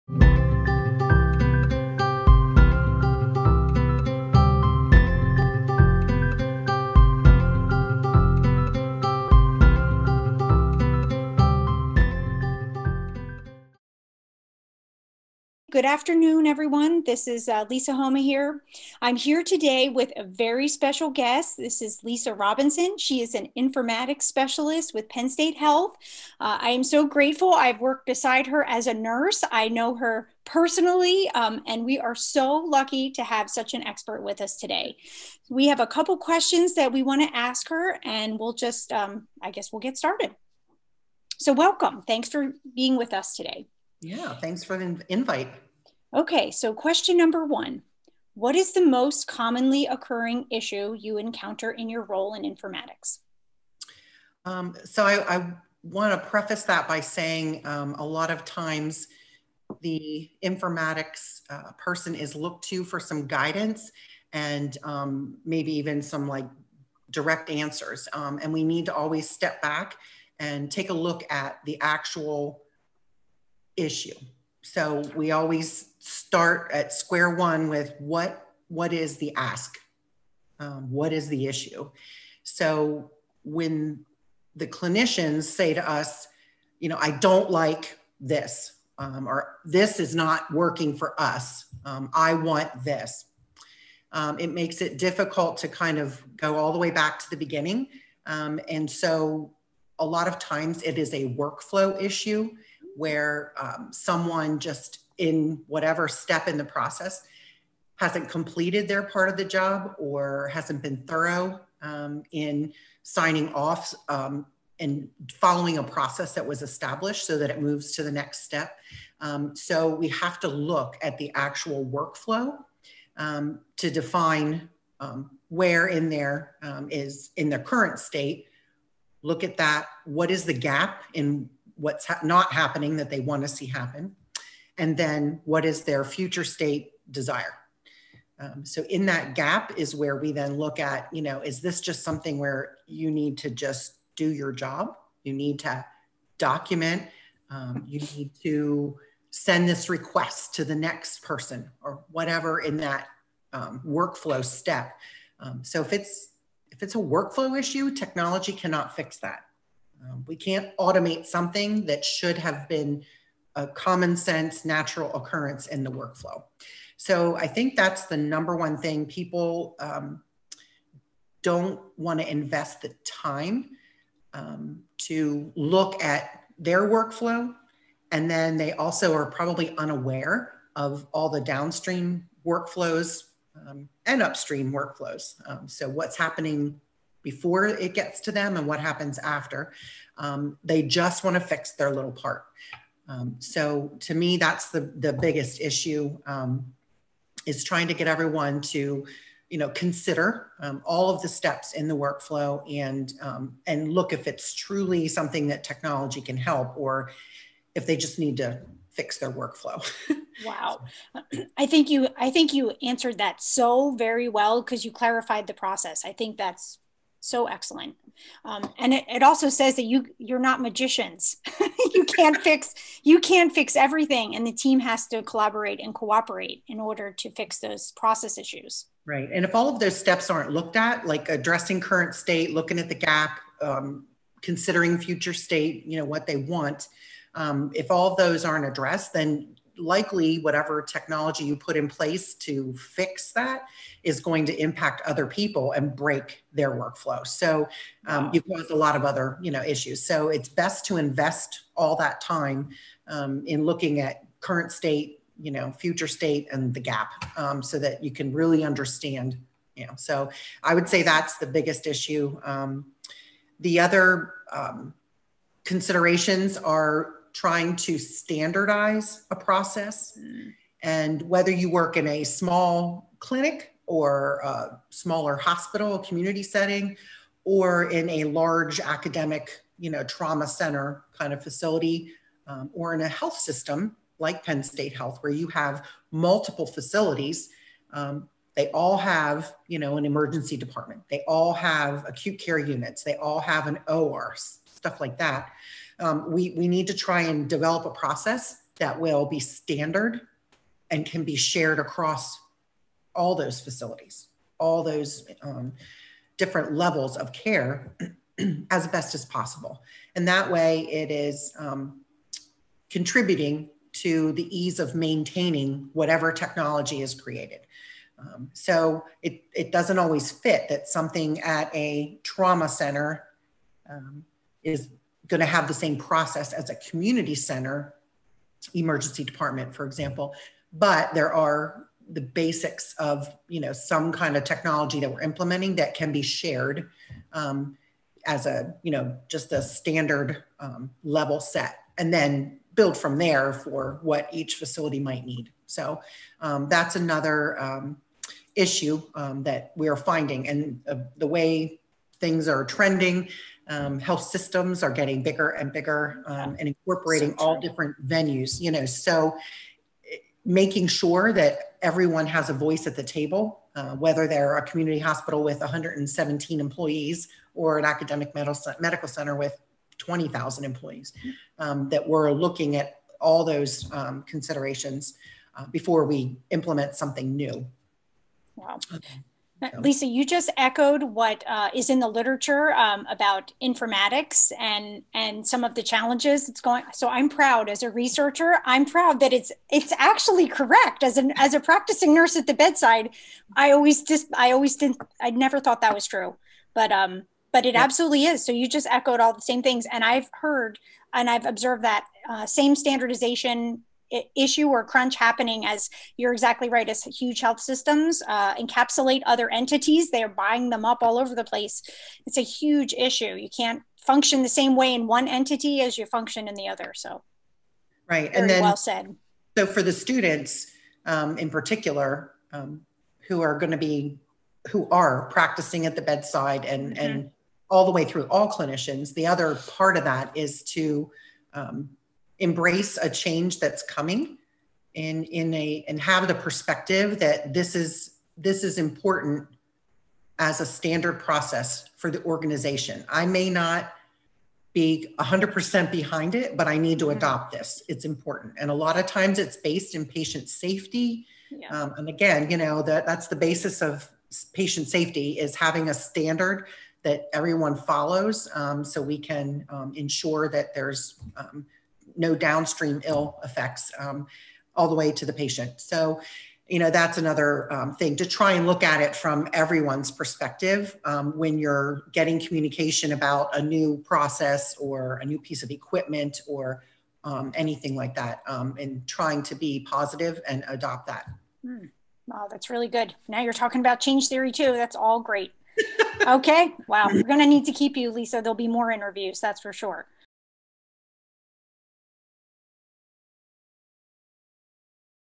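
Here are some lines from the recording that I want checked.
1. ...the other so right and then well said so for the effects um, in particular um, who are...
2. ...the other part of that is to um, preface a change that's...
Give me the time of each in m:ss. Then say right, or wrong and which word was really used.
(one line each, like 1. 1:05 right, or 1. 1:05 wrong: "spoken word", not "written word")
1. 6:56 wrong: "students", not "effects"
2. 7:09 wrong: "embrace", not "preface".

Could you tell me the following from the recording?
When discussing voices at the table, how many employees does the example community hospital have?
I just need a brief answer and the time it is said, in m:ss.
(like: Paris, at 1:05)
117, at 6:05.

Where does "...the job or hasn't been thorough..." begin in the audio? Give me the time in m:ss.
1:49.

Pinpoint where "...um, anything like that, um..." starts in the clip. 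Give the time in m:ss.
7:57.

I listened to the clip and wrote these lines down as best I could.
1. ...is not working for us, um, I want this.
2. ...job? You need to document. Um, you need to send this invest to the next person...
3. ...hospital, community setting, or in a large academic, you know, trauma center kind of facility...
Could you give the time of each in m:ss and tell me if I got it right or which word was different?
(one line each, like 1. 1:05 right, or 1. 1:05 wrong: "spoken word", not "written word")
1. 1:29 right
2. 2:24 wrong: "request", not "invest"
3. 4:35 right.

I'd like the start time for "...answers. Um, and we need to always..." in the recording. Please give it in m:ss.
1:07.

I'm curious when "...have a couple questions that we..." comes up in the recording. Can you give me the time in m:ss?
0:35.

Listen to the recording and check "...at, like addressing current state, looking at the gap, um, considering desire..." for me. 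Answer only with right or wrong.
wrong.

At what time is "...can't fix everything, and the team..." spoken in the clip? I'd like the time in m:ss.
3:43.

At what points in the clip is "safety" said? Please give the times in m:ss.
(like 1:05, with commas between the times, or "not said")
7:30, 7:34.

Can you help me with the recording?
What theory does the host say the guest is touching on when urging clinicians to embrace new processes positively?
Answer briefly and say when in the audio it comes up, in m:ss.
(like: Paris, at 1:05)
Change theory, at 8:03.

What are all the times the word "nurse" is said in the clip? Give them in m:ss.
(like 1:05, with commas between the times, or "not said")
0:28, 6:32.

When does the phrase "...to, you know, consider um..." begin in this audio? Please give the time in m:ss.
3:18.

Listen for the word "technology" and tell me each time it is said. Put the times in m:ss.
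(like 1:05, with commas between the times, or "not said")
2:37, 3:25, 4:00, 5:16, 5:34.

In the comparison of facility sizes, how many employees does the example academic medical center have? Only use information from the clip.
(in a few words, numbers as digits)
20,000.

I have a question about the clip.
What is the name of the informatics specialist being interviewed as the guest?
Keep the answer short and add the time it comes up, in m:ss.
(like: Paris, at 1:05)
Lisa Robinson, at 0:22.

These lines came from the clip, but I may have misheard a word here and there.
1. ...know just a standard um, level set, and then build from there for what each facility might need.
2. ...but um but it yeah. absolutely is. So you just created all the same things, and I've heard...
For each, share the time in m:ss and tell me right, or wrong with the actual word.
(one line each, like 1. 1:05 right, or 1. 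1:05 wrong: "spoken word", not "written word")
1. 5:38 right
2. 6:36 wrong: "echoed", not "created".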